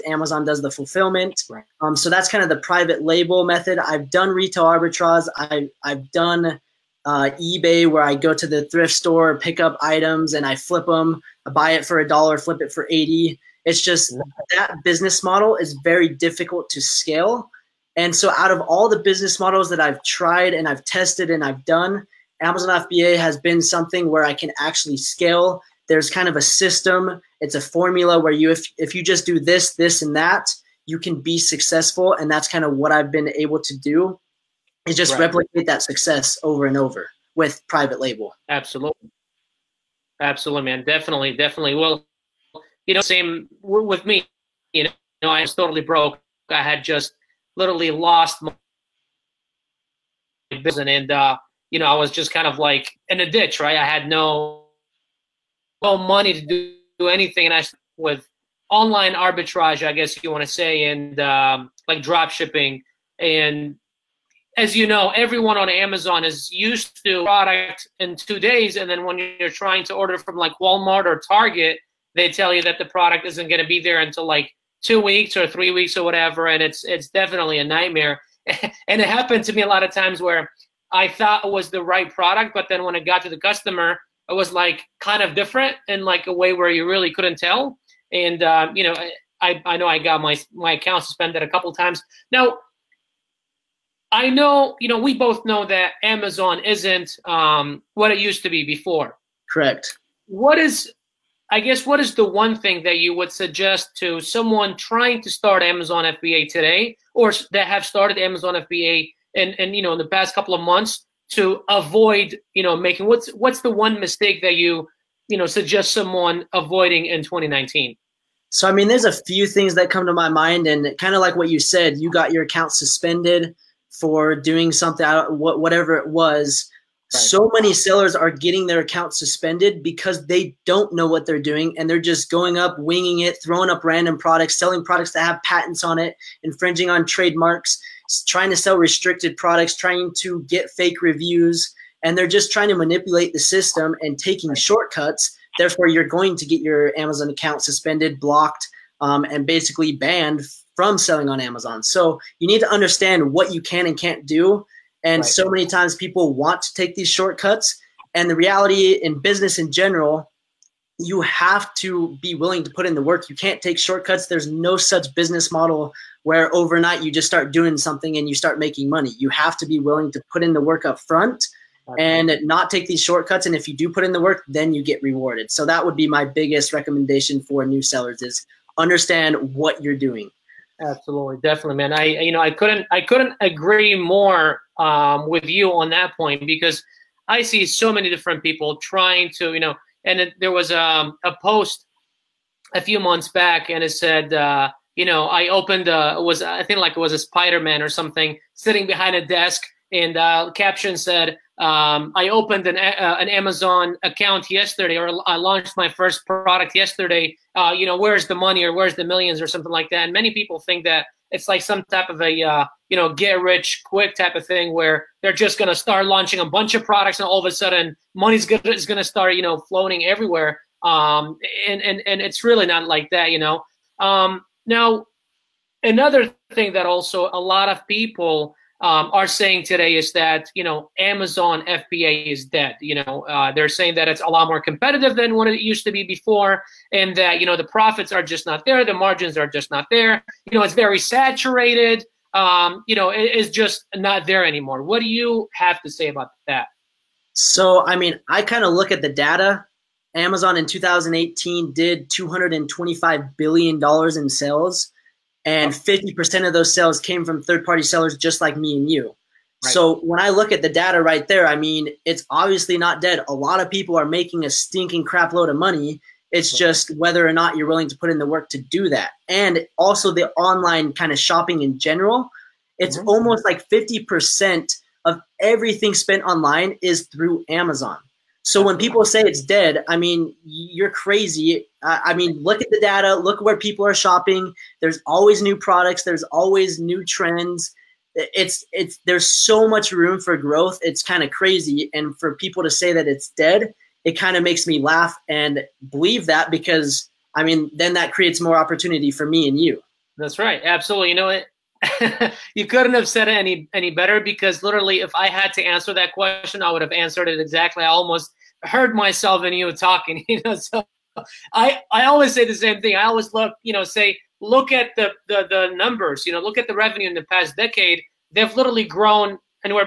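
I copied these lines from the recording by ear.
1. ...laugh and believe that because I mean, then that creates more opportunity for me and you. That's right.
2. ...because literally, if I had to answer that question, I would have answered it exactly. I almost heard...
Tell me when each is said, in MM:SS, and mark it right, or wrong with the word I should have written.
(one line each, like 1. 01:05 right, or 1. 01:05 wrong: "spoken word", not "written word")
1. 04:54 right
2. 05:04 right.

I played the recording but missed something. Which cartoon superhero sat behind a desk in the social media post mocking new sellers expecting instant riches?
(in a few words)
Spider Man.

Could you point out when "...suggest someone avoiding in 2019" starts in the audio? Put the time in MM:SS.
01:55.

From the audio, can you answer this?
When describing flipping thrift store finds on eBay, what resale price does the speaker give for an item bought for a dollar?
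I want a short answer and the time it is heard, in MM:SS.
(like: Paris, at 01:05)
$80, at 00:12.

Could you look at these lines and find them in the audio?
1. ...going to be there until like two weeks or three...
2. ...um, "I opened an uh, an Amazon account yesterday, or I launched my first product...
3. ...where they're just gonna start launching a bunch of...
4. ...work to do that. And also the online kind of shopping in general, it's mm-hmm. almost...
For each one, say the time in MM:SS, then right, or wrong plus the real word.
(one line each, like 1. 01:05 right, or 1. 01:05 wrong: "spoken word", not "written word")
1. 01:13 right
2. 03:21 right
3. 03:34 right
4. 04:28 right.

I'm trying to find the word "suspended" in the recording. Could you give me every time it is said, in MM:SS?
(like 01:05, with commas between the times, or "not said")
01:31, 02:02, 02:09, 02:27.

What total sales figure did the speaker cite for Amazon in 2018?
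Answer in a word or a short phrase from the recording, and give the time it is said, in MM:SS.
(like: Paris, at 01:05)
$225 billion, at 04:12.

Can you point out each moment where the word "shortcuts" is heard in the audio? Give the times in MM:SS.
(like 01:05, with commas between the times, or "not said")
02:24, 02:37, 02:43, 02:53.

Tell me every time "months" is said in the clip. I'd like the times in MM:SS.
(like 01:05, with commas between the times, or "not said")
01:50, 03:12.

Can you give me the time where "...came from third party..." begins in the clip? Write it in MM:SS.
04:16.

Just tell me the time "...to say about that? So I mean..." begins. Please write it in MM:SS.
04:05.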